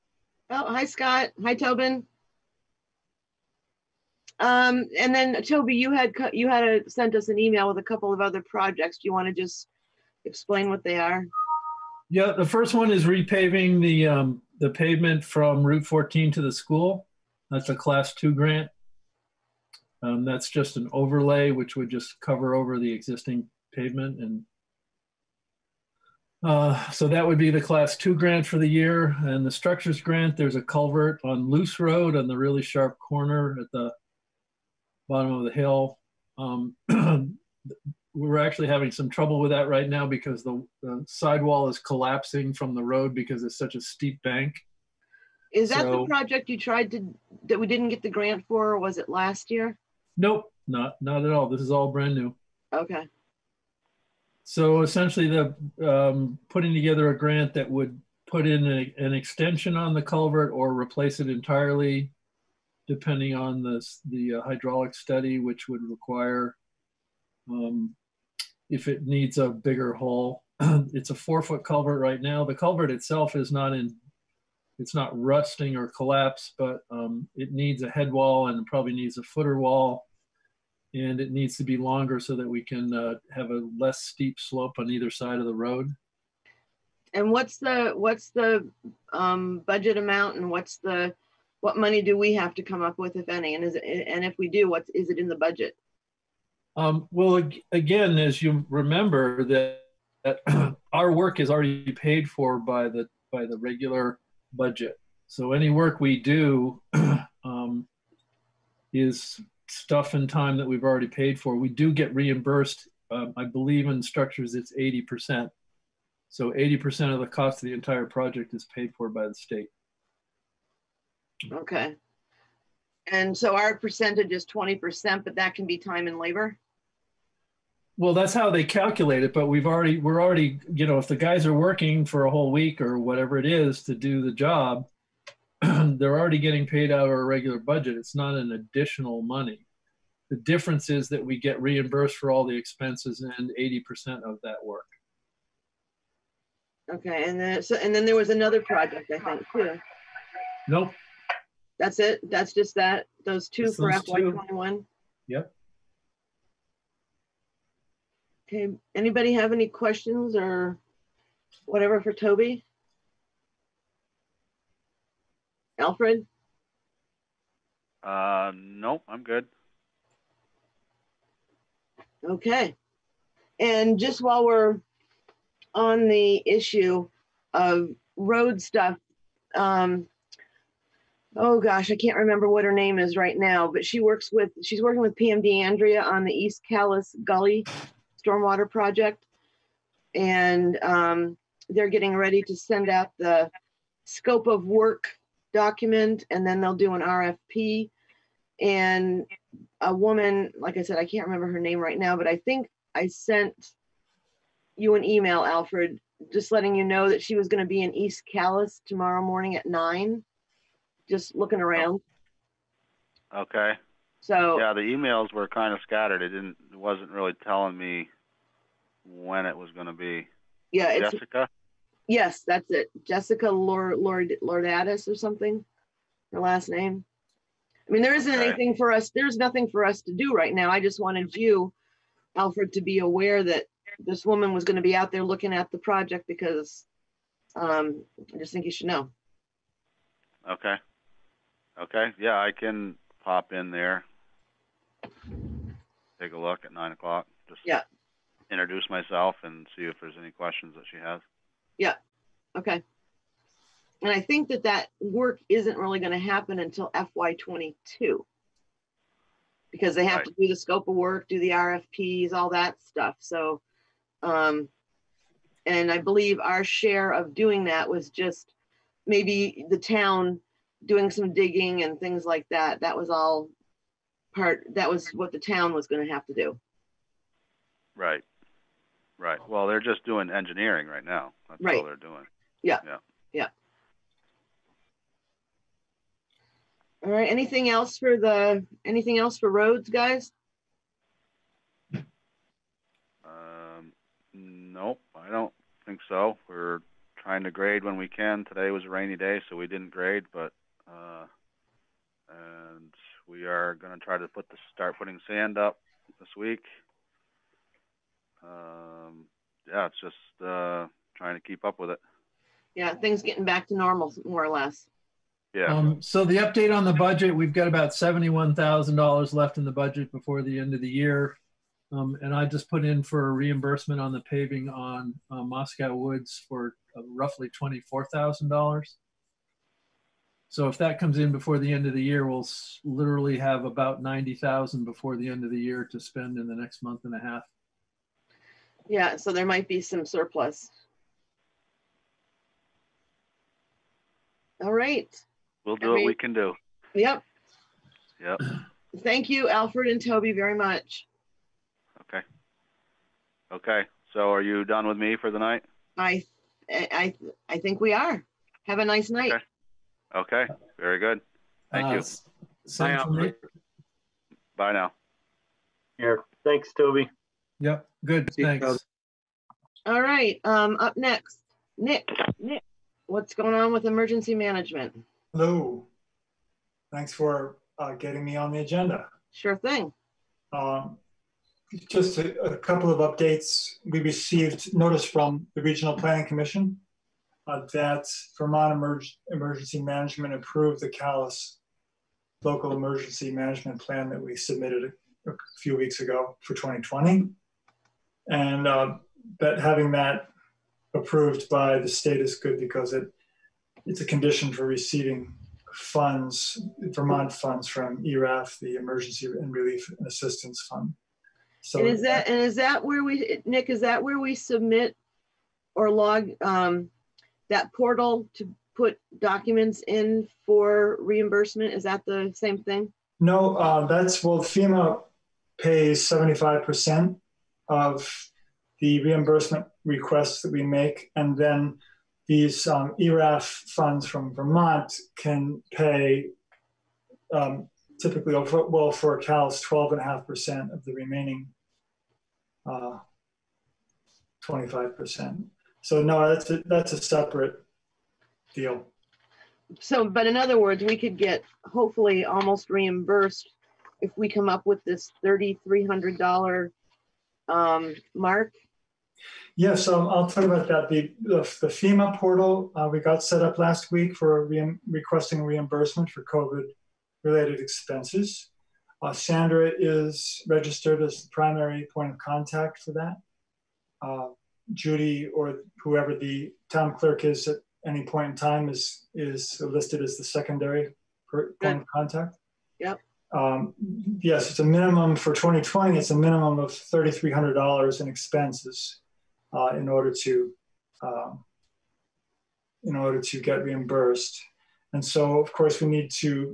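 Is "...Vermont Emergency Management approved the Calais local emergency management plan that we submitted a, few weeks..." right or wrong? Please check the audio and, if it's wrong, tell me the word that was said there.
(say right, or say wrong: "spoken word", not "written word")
right.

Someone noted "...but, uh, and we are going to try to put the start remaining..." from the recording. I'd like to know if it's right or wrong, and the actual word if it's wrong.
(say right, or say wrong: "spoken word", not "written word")
wrong: "putting", not "remaining".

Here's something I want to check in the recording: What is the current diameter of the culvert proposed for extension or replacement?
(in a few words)
4 feet.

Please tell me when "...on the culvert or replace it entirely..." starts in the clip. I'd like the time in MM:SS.
00:59.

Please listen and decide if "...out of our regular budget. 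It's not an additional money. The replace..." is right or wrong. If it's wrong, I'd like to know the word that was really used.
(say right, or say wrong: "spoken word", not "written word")
wrong: "difference", not "replace".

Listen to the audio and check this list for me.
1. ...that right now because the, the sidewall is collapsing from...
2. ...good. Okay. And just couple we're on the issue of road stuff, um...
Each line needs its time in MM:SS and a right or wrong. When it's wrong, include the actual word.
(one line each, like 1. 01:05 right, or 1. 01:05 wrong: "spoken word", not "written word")
1. 00:39 right
2. 02:49 wrong: "while", not "couple".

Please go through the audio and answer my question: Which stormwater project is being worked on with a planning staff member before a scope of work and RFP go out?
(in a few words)
East Calais Gully.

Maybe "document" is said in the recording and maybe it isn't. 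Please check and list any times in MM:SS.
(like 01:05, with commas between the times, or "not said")
03:15, 06:59.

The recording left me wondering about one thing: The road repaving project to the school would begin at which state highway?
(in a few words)
Route 14.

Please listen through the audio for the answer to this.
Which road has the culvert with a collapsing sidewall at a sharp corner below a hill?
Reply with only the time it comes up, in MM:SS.
00:31.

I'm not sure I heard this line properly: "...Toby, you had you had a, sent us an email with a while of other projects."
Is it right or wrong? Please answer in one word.
wrong.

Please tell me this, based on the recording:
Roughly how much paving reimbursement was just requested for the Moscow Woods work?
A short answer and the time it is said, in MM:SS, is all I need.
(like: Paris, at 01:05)
$24,000, at 05:27.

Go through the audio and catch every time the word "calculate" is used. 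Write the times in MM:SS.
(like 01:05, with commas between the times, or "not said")
02:08.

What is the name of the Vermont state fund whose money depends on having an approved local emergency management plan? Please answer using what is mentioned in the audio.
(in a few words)
Emergency and Relief Assistance Fund.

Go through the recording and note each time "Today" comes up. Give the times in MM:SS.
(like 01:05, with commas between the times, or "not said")
04:58.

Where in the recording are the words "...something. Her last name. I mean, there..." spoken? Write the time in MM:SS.
03:45.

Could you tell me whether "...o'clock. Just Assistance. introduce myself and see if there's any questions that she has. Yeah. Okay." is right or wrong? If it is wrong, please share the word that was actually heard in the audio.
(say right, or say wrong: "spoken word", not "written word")
wrong: "Yeah", not "Assistance".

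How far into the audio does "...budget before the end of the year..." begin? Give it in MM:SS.
05:19.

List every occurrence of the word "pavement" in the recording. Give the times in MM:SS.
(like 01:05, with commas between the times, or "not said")
00:14, 00:23.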